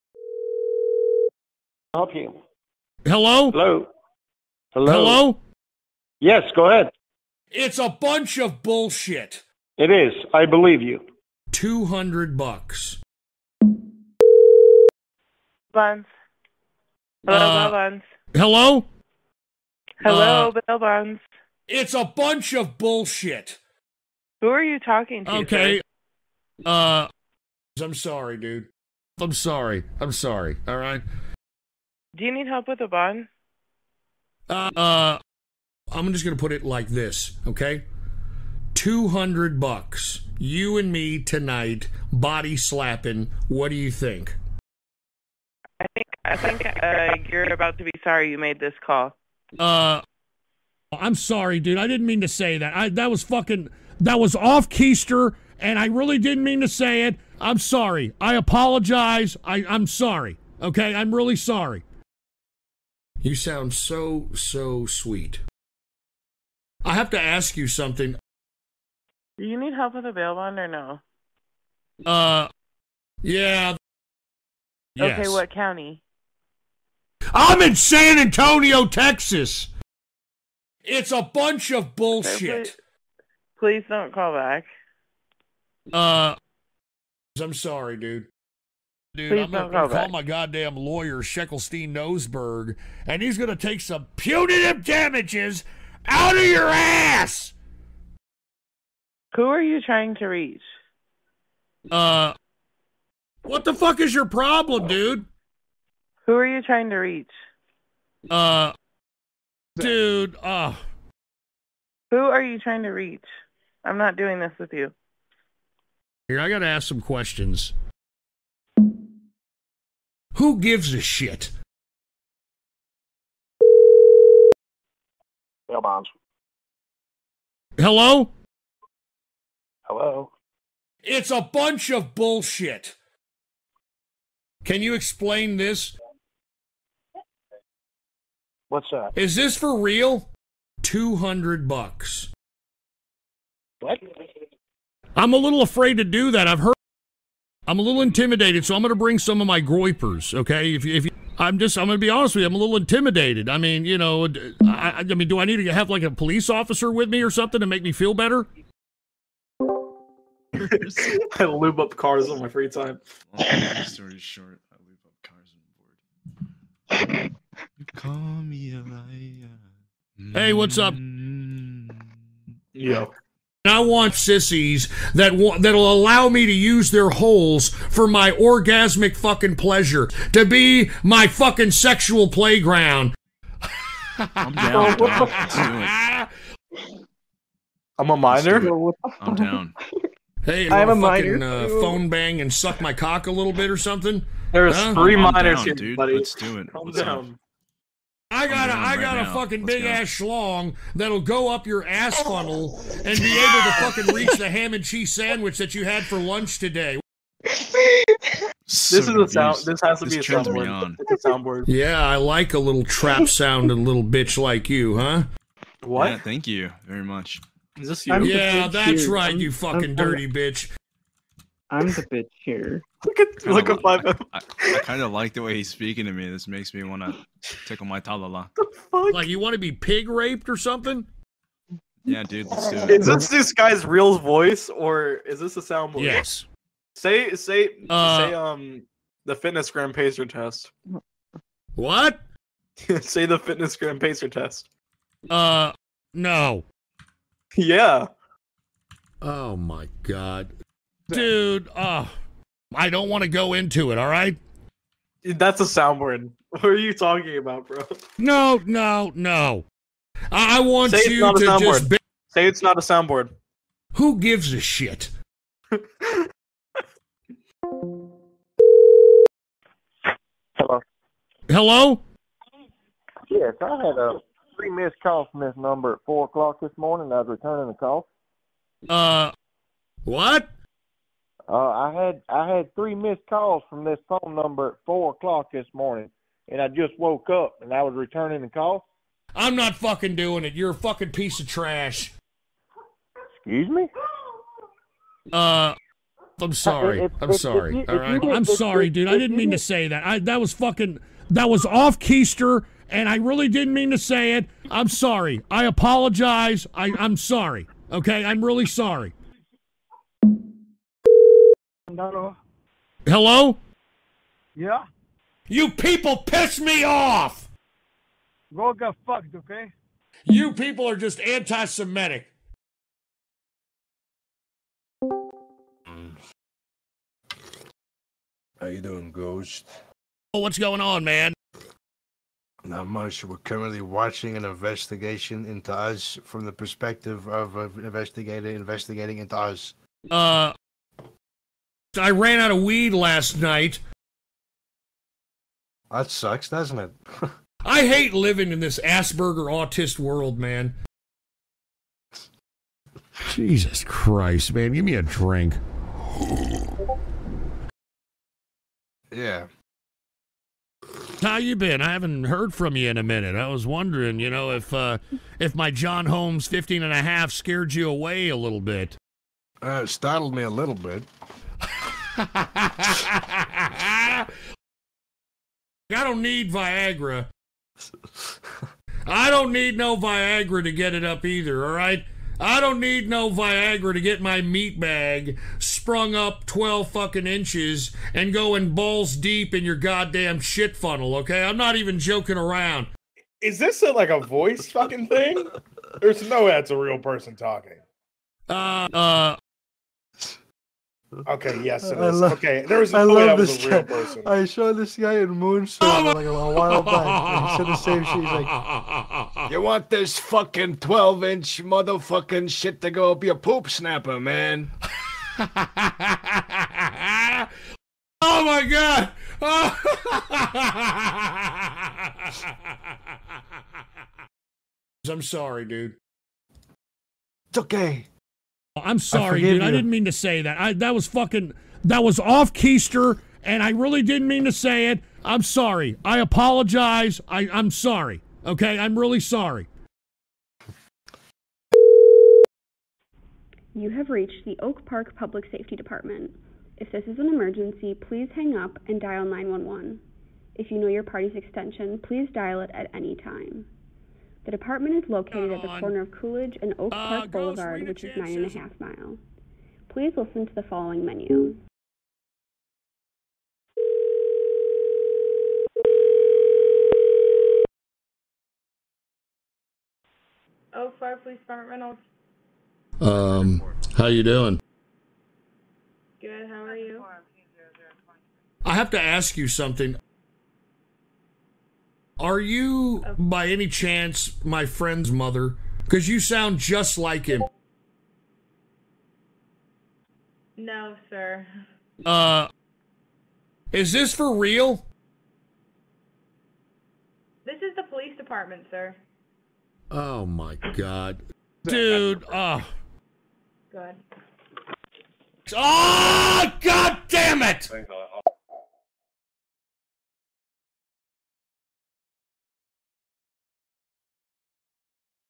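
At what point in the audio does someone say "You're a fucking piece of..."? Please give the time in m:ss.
4:50.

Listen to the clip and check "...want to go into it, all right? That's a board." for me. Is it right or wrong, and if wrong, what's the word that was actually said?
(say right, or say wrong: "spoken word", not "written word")
wrong: "soundboard", not "board".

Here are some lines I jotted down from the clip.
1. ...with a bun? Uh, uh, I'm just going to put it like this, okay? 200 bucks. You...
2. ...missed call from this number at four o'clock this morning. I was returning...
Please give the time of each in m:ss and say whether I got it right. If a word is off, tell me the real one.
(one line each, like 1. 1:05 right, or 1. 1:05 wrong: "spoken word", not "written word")
1. 0:32 right
2. 4:34 right.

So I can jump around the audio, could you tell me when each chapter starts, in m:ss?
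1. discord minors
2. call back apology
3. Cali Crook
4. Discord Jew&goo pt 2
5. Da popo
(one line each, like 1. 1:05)
1. 2:39
2. 4:28
3. 5:10
4. 5:22
5. 7:21.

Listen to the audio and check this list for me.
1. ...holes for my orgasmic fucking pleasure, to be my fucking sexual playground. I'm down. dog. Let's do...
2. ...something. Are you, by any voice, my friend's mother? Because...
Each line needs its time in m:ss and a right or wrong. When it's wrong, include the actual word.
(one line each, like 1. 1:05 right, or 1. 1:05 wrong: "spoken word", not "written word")
1. 2:57 right
2. 7:59 wrong: "chance", not "voice".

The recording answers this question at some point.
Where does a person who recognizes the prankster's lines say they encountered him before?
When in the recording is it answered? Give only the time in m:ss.
6:45.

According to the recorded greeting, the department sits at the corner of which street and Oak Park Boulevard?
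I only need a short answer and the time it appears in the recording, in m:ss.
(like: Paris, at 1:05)
Coolidge, at 7:36.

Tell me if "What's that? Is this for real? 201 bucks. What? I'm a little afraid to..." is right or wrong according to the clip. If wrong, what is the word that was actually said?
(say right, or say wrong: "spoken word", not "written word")
wrong: "200", not "201".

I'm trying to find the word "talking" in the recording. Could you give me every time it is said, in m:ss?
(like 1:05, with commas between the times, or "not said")
0:24, 4:16, 6:37.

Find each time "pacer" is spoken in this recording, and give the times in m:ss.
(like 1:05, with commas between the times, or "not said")
3:59, 4:03.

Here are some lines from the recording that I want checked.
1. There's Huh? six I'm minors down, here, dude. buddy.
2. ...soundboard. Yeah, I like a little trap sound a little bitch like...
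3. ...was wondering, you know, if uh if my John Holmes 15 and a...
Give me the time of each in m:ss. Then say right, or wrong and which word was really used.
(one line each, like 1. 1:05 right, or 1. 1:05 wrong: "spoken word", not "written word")
1. 3:14 wrong: "three", not "six"
2. 3:31 right
3. 6:03 right.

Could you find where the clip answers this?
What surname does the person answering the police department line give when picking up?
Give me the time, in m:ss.
7:51.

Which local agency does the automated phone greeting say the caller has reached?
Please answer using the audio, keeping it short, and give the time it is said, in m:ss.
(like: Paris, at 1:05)
Oak Park Public Safety Department, at 7:24.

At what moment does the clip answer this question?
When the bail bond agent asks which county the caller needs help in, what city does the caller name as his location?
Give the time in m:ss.
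1:17.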